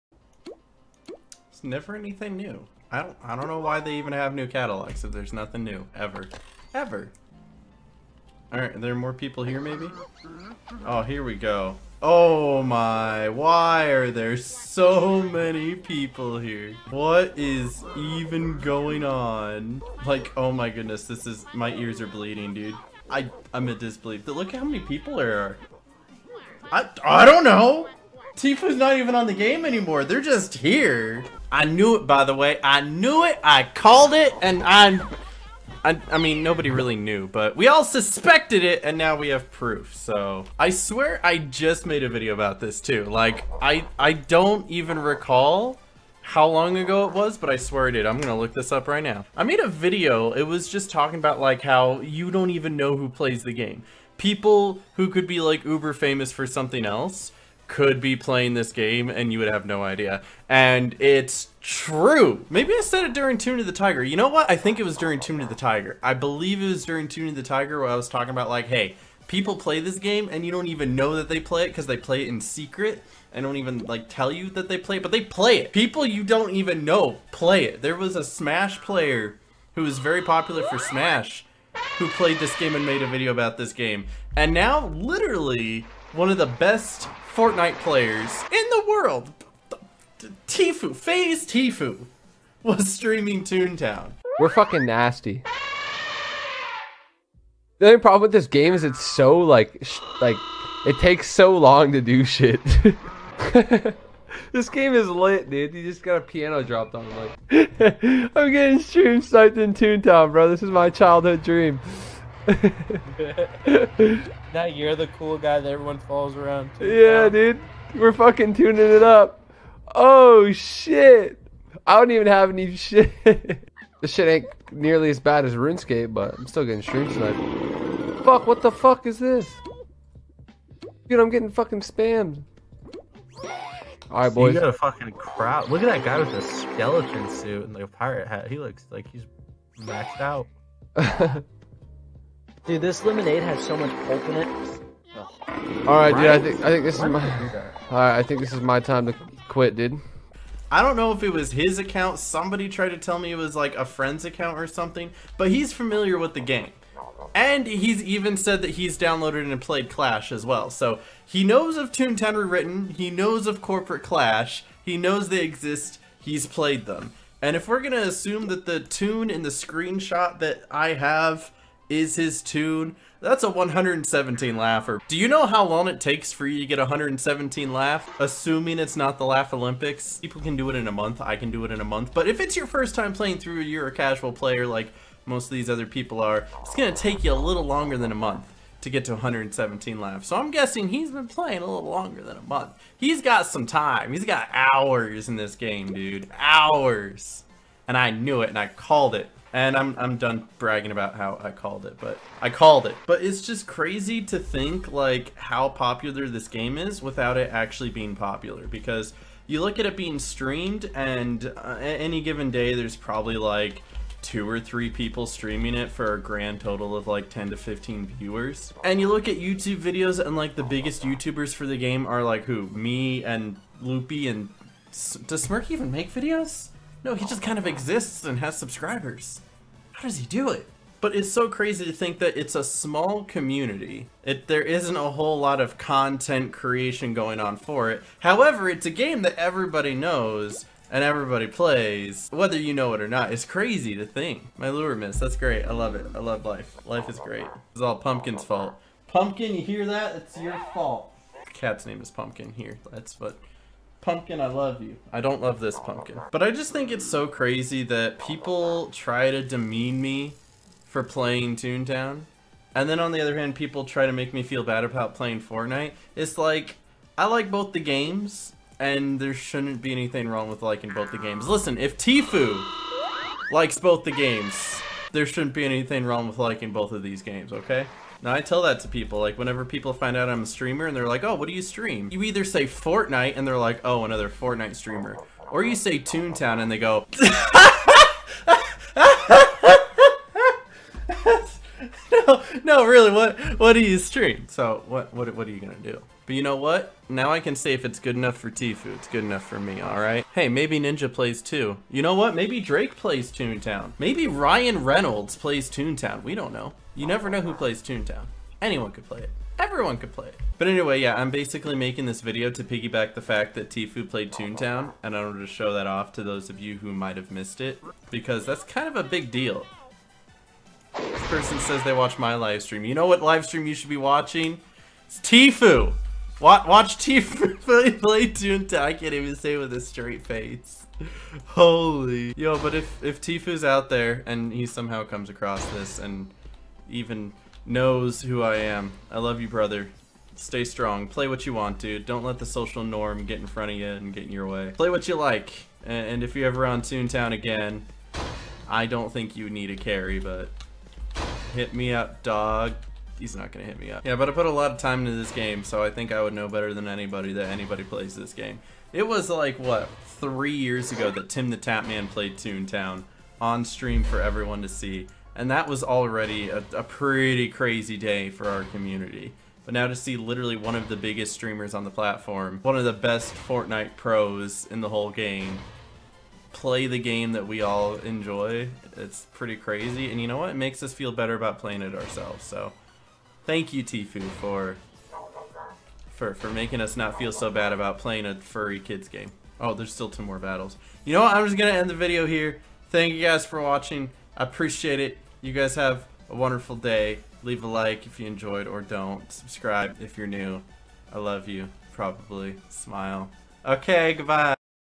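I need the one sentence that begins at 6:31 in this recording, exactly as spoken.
I'm just gonna end the video here.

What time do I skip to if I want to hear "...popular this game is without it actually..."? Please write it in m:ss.
3:25.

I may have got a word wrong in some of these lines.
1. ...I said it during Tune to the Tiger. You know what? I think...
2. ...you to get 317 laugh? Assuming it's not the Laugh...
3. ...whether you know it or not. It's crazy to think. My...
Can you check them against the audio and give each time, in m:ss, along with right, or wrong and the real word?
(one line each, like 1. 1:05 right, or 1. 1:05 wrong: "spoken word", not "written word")
1. 1:02 right
2. 2:56 wrong: "117", not "317"
3. 4:02 right.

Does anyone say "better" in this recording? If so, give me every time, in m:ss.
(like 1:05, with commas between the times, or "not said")
5:56, 6:21.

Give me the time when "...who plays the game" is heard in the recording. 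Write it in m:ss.
0:52.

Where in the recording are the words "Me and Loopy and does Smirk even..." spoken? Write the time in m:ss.
3:42.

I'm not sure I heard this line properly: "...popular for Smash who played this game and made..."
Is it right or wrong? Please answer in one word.
right.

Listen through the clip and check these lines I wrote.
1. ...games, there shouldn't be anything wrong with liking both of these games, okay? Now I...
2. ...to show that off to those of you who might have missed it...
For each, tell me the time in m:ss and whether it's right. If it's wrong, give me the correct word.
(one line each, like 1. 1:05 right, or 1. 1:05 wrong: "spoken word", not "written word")
1. 4:34 right
2. 5:15 right.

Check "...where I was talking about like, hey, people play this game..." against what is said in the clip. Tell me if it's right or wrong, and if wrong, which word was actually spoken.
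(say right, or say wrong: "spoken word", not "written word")
right.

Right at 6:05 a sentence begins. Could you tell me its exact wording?
And that was already a, a pretty crazy day for our community.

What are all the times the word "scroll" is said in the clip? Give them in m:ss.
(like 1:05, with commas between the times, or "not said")
not said.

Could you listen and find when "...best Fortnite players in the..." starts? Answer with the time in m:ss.
1:26.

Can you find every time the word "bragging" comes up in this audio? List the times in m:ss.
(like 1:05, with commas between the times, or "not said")
3:20.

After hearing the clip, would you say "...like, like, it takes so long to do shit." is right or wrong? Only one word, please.
right.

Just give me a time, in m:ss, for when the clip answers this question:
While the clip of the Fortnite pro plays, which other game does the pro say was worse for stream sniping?
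2:05.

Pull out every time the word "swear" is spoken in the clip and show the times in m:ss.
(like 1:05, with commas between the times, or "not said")
0:40, 0:47.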